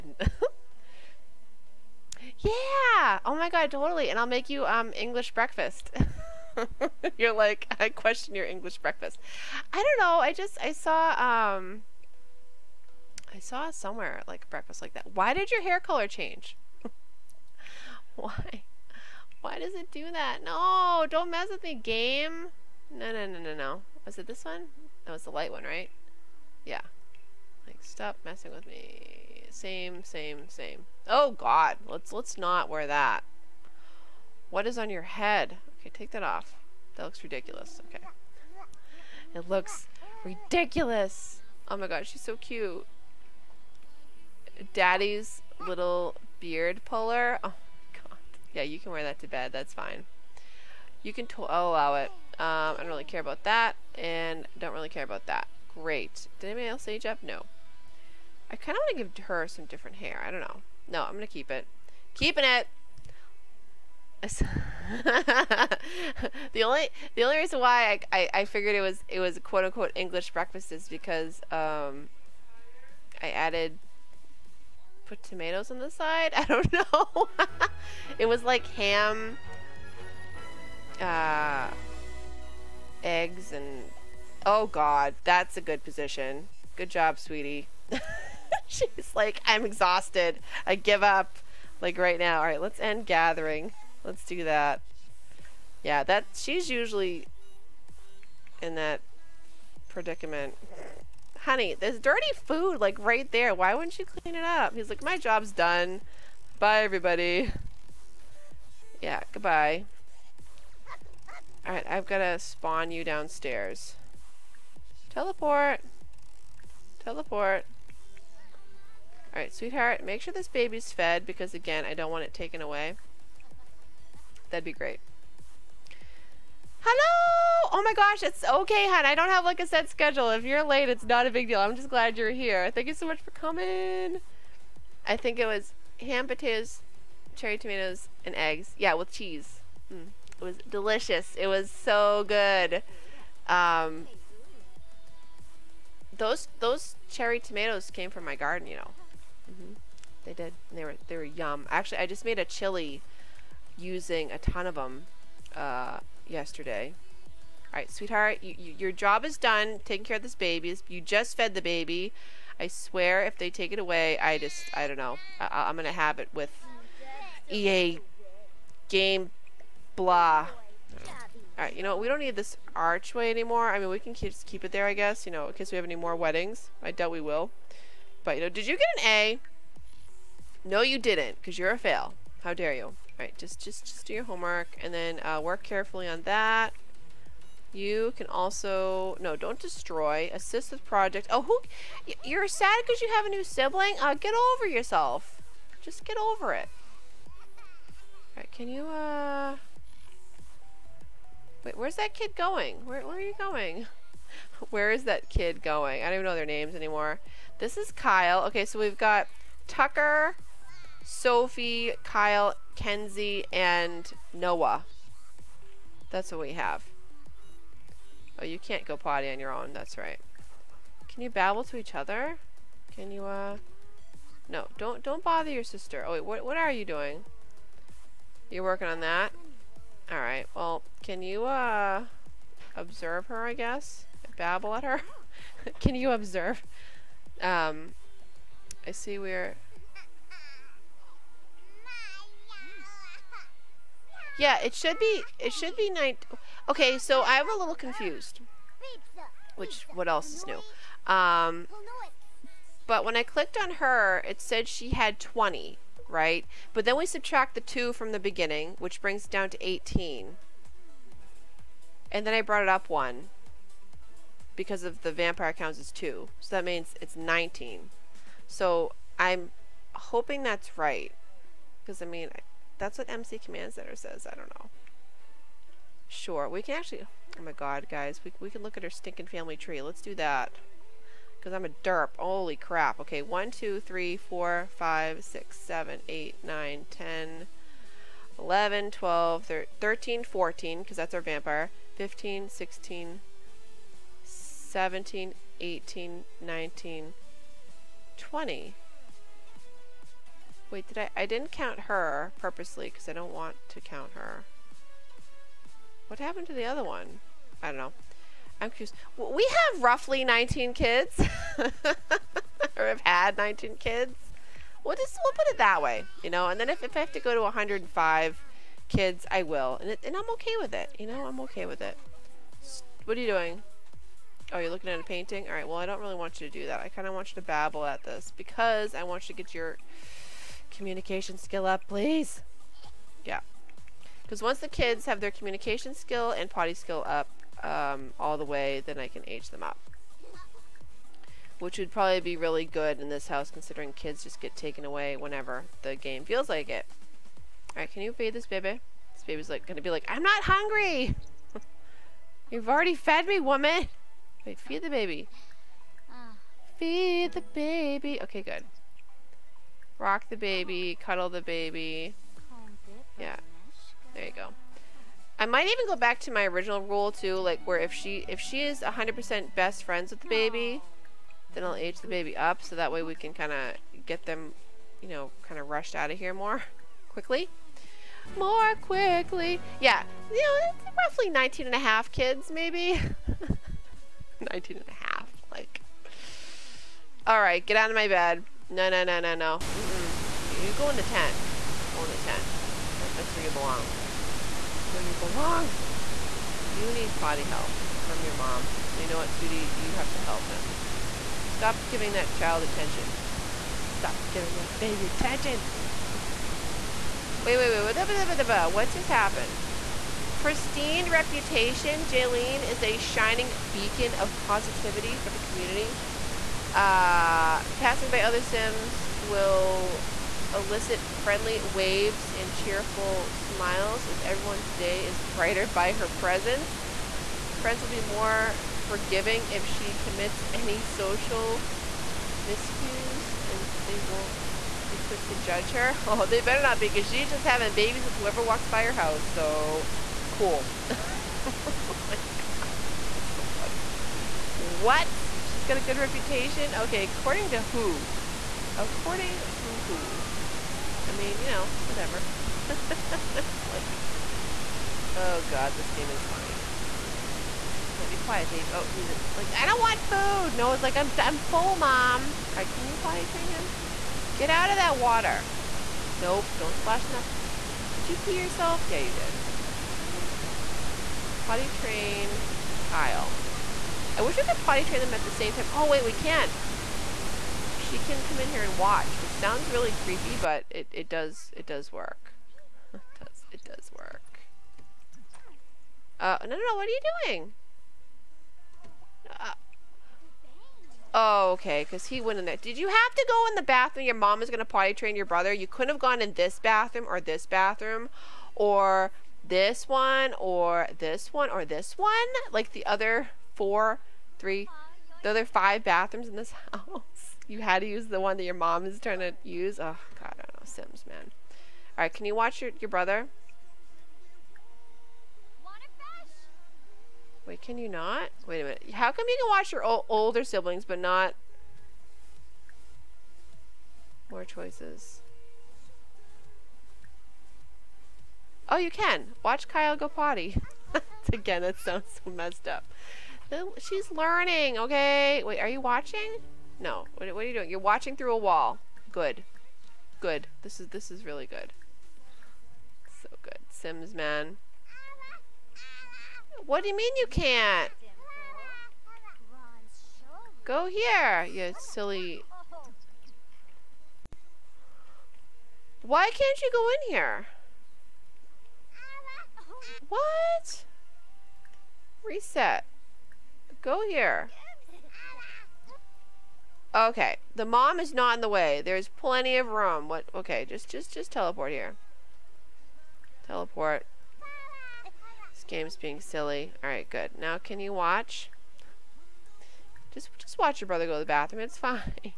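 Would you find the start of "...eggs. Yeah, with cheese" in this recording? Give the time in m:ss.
2:18.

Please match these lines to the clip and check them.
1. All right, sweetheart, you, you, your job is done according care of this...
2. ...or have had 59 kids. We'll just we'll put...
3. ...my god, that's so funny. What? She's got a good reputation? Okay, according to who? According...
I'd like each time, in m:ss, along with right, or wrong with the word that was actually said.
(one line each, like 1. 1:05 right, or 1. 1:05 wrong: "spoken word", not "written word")
1. 2:37 wrong: "taking", not "according"
2. 5:11 wrong: "19", not "59"
3. 7:22 right.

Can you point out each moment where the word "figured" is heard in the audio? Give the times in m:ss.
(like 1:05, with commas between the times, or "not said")
1:08.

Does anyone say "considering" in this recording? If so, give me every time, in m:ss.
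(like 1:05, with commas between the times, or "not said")
5:43.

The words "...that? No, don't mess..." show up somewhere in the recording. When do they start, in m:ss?
0:20.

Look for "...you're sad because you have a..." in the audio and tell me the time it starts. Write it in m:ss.
3:12.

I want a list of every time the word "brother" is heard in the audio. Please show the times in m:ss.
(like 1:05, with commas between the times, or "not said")
8:15, 8:32, 9:40.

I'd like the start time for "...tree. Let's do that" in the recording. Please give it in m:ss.
4:39.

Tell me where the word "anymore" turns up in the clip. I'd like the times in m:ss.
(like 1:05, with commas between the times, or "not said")
2:53, 3:26.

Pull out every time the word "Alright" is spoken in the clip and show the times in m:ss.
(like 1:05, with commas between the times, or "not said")
1:32, 1:51, 1:59, 2:51, 3:03, 3:50, 5:47, 7:42.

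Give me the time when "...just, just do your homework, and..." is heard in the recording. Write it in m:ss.
3:03.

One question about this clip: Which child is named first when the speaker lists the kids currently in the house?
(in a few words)
Tucker.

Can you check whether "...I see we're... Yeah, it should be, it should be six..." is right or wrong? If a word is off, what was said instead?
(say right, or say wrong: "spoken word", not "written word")
wrong: "nine", not "six".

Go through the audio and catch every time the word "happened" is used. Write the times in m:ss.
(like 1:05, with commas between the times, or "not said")
5:06, 6:49.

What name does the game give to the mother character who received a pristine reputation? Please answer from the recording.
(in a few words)
Jaylene.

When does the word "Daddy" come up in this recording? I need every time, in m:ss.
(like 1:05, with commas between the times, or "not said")
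0:44.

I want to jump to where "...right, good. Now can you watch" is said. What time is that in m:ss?
9:36.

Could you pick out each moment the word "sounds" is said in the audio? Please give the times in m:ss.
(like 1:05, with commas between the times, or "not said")
7:59, 8:51.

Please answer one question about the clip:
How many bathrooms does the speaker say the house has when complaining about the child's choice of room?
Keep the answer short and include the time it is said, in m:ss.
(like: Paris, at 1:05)
5, at 8:25.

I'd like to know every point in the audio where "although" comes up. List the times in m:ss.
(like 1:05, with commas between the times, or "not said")
not said.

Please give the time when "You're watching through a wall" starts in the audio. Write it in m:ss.
8:57.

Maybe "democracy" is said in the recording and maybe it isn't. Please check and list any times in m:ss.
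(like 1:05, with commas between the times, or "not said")
not said.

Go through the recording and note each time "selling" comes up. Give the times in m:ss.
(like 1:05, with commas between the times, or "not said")
not said.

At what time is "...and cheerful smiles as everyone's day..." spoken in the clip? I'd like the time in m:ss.
7:02.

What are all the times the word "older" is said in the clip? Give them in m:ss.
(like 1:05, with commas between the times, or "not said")
8:40.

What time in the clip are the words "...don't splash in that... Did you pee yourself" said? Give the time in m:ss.
7:46.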